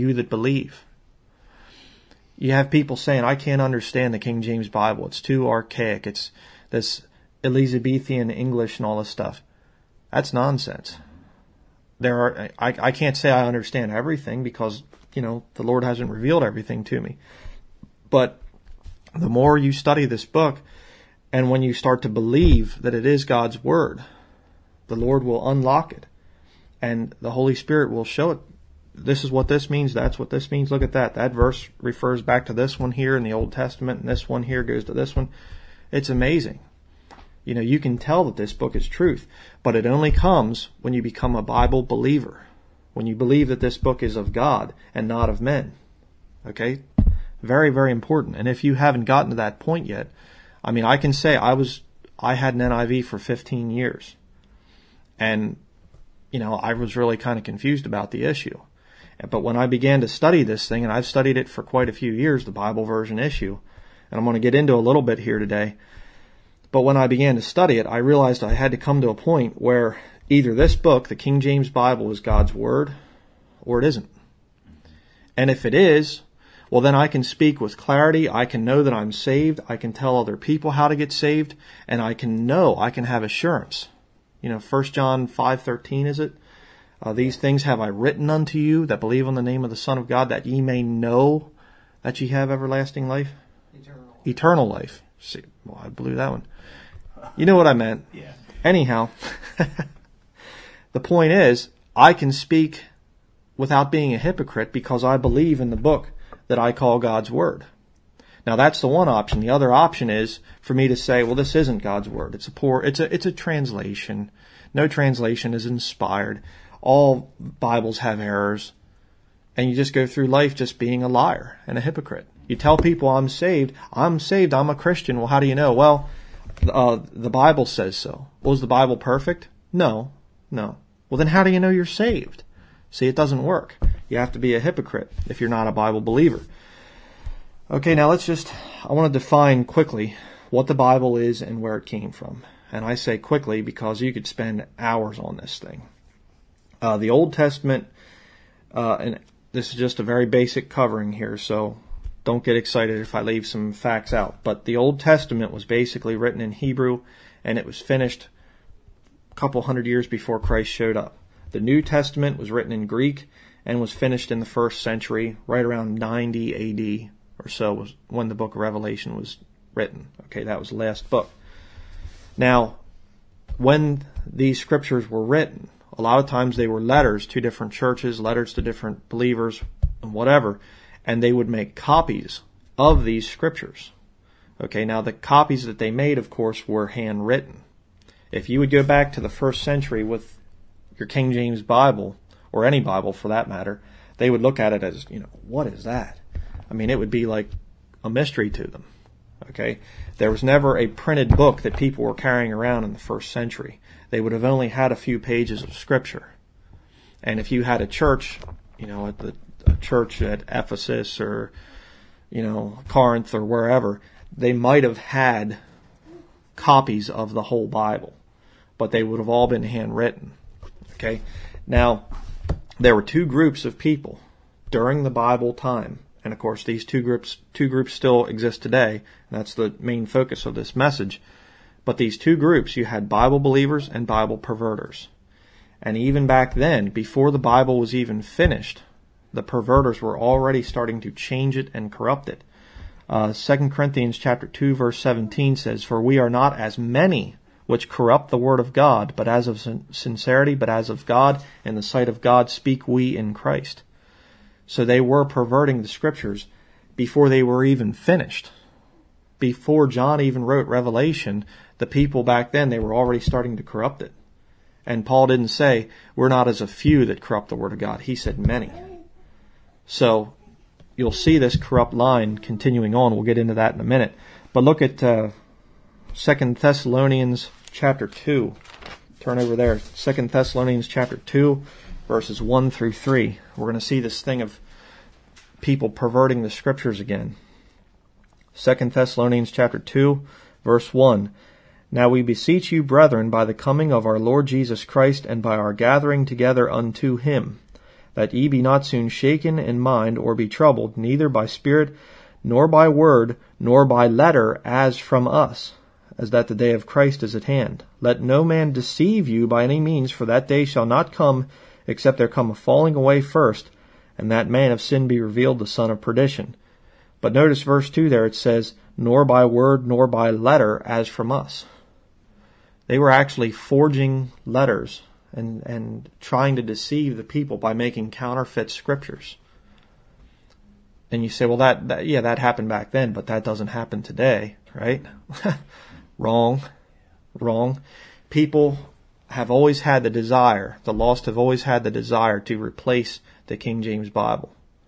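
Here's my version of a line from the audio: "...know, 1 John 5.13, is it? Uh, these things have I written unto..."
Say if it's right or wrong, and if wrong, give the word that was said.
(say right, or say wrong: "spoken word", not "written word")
right.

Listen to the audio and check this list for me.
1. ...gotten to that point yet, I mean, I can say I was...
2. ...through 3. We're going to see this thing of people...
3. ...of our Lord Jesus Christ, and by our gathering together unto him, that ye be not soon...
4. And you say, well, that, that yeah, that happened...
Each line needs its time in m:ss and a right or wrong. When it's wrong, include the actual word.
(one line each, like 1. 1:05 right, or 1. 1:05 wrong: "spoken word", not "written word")
1. 0:49 right
2. 4:42 right
3. 4:53 right
4. 5:31 right.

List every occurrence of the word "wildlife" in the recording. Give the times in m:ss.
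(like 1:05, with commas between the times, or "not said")
not said.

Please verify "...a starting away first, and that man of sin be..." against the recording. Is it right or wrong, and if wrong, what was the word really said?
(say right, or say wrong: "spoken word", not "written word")
wrong: "falling", not "starting".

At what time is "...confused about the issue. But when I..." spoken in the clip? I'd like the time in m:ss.
0:57.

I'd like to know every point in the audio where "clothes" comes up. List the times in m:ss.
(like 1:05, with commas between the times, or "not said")
not said.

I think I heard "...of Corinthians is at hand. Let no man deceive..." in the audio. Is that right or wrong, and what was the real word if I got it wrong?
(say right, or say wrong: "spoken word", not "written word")
wrong: "Christ", not "Corinthians".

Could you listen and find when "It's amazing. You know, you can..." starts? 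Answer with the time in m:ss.
0:35.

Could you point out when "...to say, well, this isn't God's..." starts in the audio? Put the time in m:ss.
1:50.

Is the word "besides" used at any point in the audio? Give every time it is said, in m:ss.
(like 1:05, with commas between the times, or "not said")
not said.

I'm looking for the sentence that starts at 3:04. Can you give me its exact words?
Okay, now the copies that they made, of course, were handwritten.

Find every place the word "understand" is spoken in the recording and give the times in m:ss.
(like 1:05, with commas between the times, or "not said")
0:03, 0:13.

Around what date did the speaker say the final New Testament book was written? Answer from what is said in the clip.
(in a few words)
90 AD.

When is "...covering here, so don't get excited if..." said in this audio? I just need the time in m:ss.
2:30.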